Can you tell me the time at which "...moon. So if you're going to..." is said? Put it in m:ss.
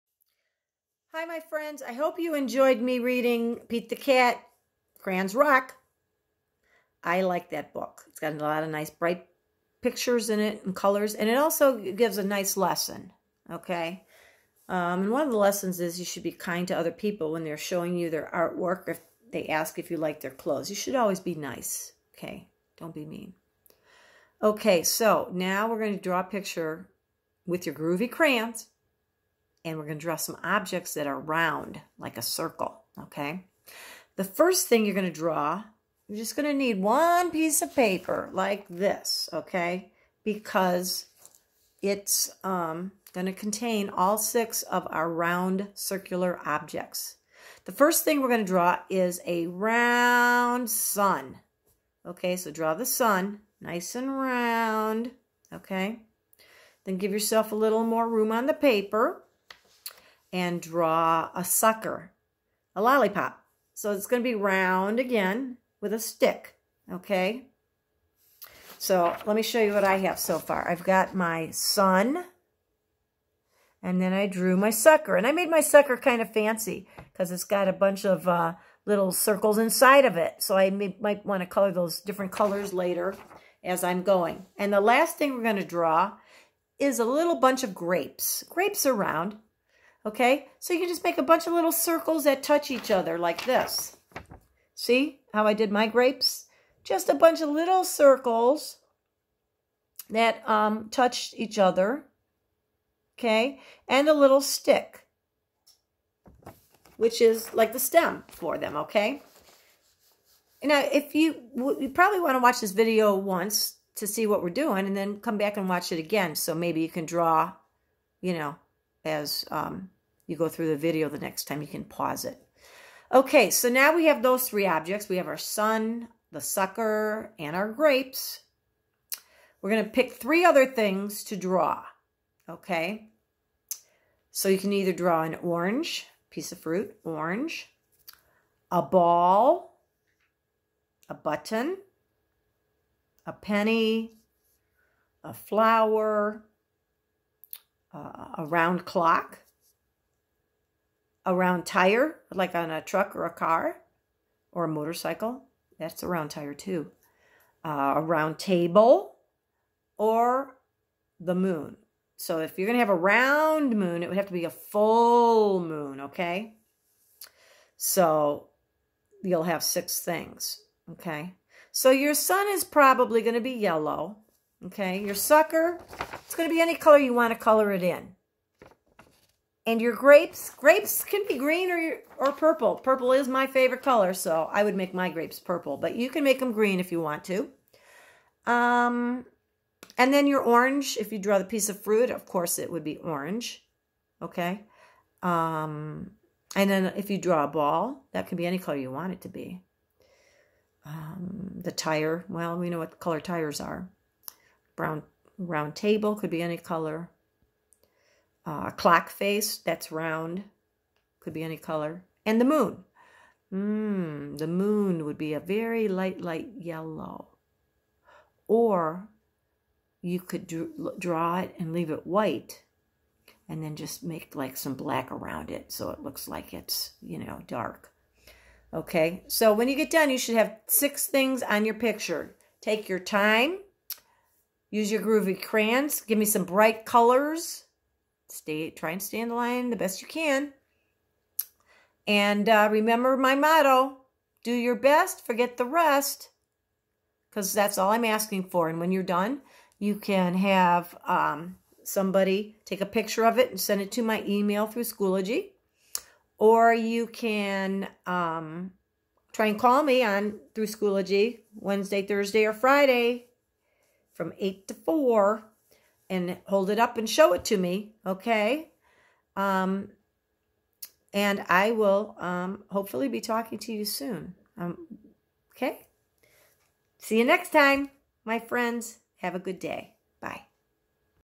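2:41.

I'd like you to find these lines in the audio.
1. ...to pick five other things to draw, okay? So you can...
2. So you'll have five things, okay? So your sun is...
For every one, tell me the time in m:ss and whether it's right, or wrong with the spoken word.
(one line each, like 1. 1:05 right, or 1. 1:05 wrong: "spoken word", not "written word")
1. 2:09 wrong: "three", not "five"
2. 2:47 wrong: "six", not "five".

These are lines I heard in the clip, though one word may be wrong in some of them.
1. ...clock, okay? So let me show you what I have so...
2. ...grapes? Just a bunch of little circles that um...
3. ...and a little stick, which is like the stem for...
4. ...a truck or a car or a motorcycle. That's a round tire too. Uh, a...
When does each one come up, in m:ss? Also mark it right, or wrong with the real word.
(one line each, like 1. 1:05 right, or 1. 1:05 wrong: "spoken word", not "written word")
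1. 1:05 wrong: "stick", not "clock"
2. 1:35 right
3. 1:43 right
4. 2:32 right.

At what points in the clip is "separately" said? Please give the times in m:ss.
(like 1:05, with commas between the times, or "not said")
not said.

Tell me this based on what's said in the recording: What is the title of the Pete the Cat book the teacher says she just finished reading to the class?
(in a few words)
Crayons Rock.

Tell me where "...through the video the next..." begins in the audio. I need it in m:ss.
2:00.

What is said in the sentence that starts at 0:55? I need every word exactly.
Okay, then give yourself a little more room on the paper and draw a sucker, a lollipop.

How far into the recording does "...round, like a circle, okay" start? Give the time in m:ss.
0:31.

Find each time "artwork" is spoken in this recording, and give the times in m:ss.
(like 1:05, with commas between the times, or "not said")
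0:18.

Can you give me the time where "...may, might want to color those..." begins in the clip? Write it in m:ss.
1:20.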